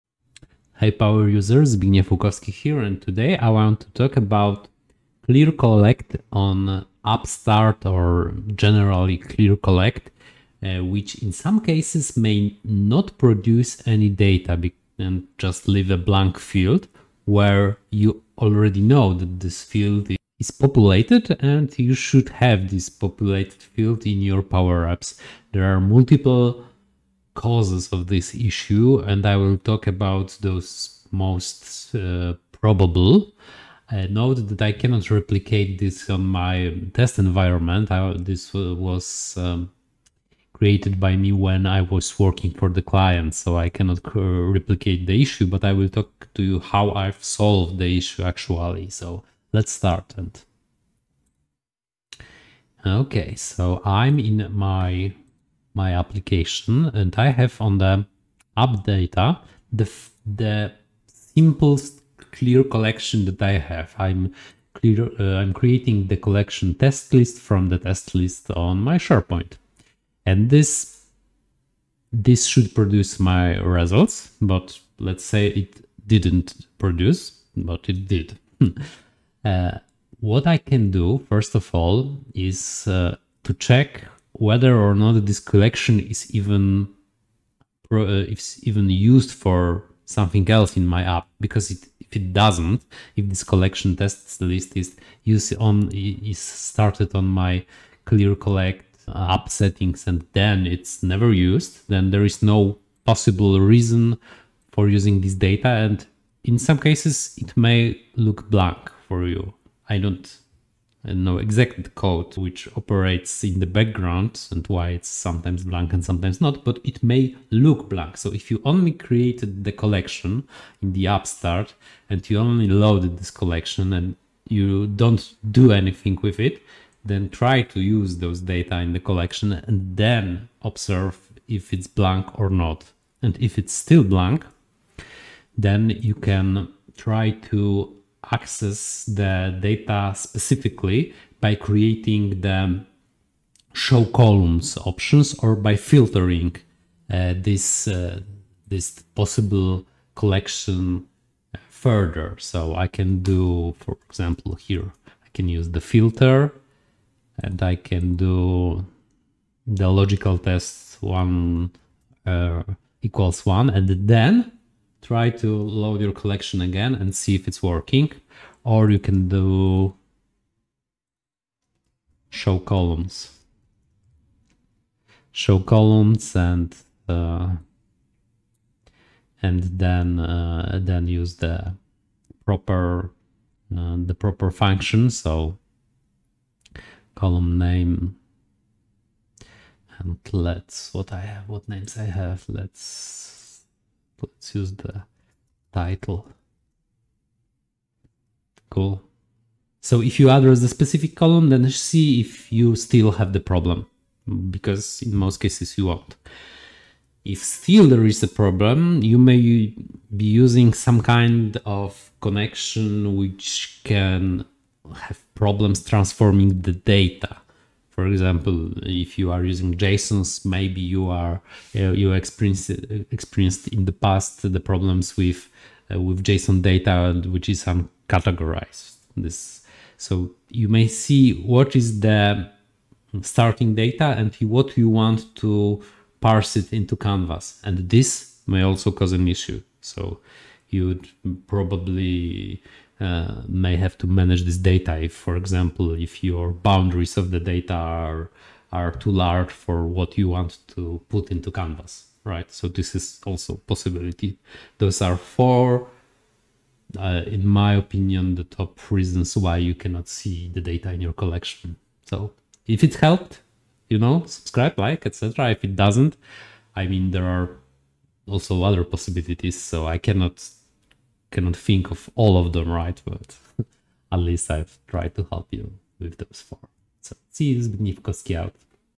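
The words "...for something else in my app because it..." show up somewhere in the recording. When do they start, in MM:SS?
01:29.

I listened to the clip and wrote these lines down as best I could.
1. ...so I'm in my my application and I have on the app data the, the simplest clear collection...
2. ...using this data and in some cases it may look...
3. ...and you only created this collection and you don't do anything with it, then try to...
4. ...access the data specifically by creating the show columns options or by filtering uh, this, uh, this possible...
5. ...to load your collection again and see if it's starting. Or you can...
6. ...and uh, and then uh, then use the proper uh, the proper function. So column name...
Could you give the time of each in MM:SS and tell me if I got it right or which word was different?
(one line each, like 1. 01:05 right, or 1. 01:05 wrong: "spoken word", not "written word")
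1. 00:53 right
2. 01:44 right
3. 02:02 wrong: "loaded", not "created"
4. 02:18 right
5. 02:45 wrong: "working", not "starting"
6. 02:56 right.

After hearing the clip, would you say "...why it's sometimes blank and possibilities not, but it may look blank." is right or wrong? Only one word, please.
wrong.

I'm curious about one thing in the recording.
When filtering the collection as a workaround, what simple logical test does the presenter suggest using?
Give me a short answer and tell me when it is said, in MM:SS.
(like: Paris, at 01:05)
1 equals 1, at 02:41.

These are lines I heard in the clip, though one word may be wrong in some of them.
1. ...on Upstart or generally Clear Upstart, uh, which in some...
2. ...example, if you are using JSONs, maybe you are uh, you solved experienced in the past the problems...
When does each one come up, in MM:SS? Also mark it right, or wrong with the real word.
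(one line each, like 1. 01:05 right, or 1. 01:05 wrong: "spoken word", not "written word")
1. 00:06 wrong: "Collect", not "Upstart"
2. 03:38 wrong: "experienced", not "solved".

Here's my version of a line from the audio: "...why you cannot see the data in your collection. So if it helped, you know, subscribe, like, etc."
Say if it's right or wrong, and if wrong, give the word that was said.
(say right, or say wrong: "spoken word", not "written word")
right.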